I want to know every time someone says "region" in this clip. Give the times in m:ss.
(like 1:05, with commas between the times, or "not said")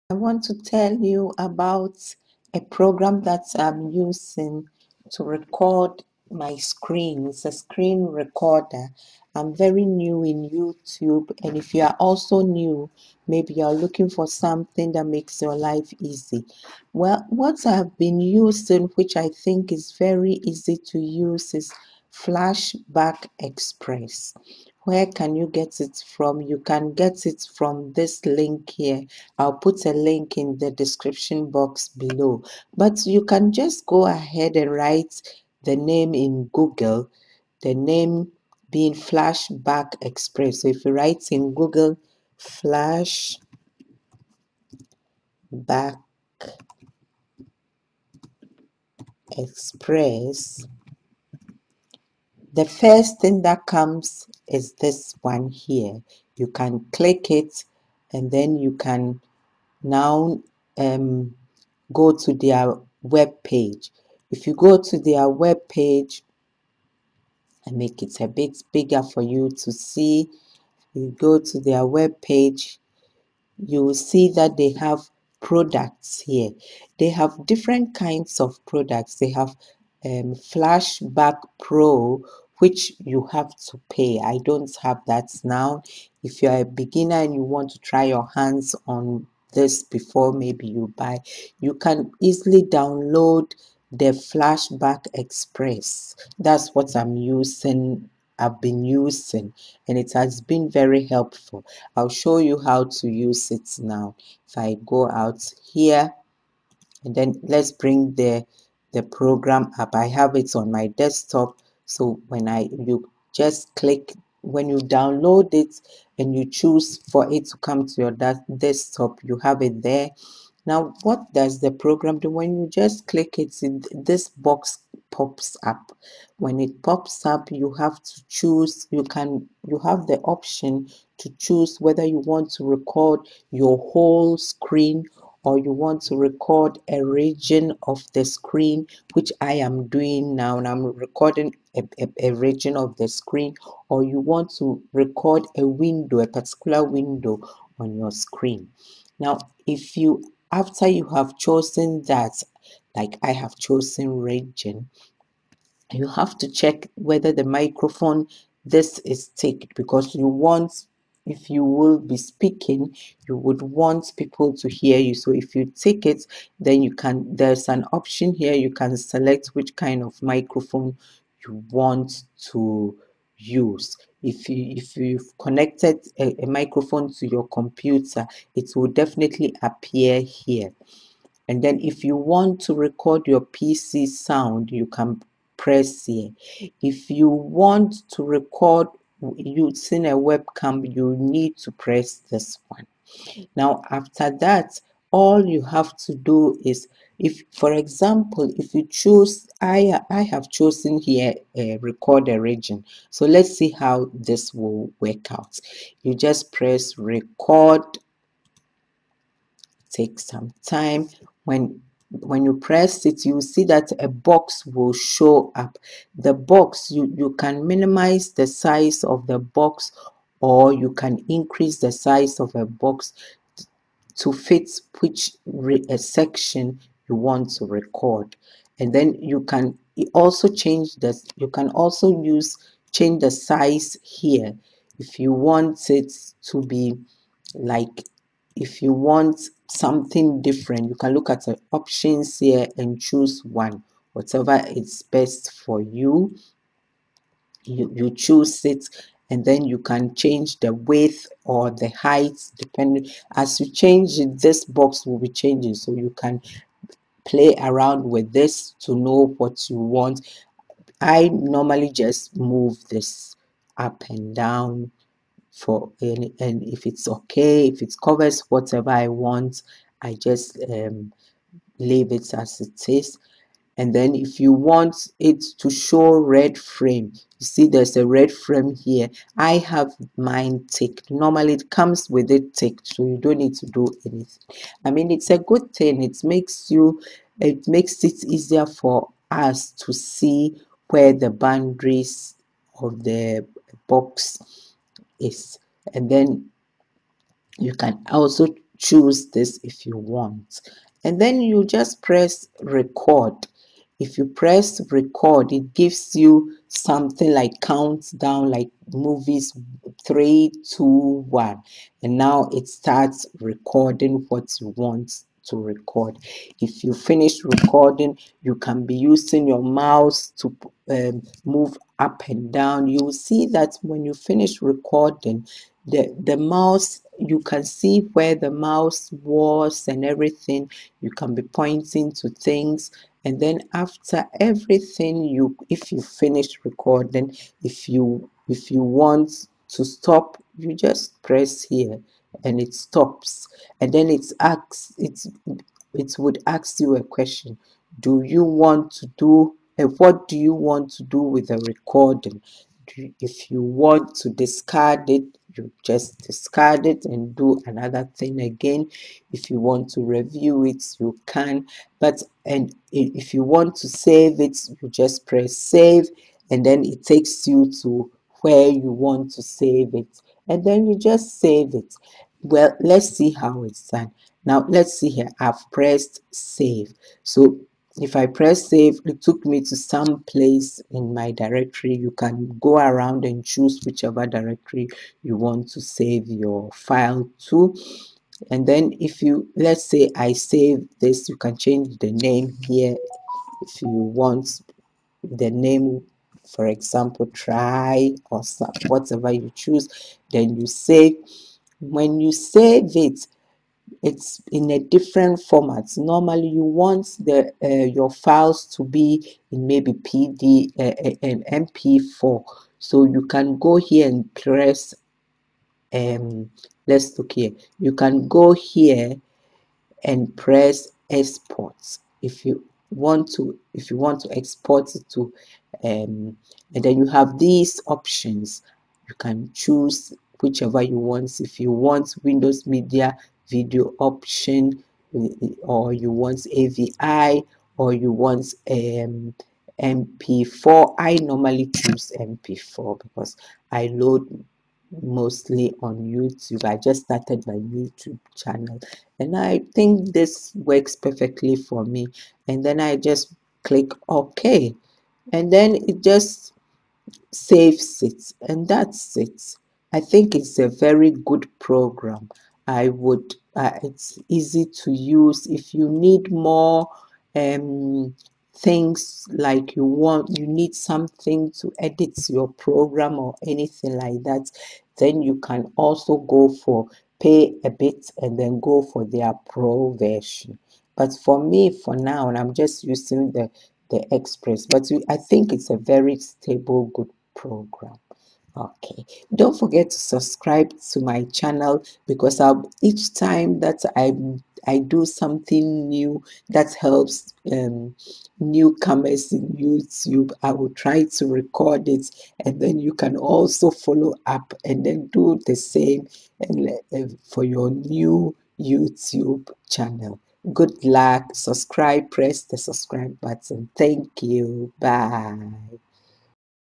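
2:17, 2:22, 2:34, 3:22.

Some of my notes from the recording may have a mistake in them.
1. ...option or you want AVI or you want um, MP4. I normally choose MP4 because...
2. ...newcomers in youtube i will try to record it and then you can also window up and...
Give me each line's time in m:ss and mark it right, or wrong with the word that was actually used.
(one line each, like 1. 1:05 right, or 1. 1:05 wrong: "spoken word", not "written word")
1. 7:13 right
2. 8:18 wrong: "follow", not "window".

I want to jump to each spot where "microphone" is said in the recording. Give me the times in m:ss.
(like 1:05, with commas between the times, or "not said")
2:37, 2:50, 2:56.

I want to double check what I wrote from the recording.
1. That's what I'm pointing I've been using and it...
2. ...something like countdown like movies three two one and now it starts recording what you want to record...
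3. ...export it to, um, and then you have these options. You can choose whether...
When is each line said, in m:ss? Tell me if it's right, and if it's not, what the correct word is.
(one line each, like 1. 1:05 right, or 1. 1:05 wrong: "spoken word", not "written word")
1. 1:36 wrong: "using", not "pointing"
2. 5:06 right
3. 7:04 wrong: "whichever", not "whether".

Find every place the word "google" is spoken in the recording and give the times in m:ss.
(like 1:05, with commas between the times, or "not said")
0:36, 0:41.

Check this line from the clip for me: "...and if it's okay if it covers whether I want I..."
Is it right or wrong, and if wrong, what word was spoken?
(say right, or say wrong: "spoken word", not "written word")
wrong: "whatever", not "whether".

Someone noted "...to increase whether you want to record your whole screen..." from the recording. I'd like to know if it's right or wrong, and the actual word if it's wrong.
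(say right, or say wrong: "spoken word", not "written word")
wrong: "choose", not "increase".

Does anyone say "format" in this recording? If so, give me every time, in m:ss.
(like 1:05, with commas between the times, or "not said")
6:45.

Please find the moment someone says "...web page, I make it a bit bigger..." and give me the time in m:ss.
1:05.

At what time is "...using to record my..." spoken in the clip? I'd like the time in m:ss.
0:03.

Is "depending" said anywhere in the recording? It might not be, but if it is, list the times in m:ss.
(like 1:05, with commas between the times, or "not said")
4:12.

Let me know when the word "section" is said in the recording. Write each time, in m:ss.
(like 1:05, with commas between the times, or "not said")
3:45.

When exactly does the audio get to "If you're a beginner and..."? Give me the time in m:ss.
1:26.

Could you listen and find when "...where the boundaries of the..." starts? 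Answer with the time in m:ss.
4:50.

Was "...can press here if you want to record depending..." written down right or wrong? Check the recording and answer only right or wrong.
wrong.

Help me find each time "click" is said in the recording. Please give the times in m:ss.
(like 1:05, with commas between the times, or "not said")
0:56, 1:53, 2:03, 7:33.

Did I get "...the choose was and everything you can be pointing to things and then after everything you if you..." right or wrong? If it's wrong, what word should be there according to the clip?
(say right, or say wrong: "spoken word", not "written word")
wrong: "mouse", not "choose".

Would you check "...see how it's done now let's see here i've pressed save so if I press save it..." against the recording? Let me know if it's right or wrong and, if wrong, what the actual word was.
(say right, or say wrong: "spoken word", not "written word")
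right.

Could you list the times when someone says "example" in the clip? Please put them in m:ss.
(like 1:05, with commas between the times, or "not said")
3:17, 6:36.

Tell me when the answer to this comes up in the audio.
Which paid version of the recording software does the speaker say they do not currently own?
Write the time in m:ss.
1:20.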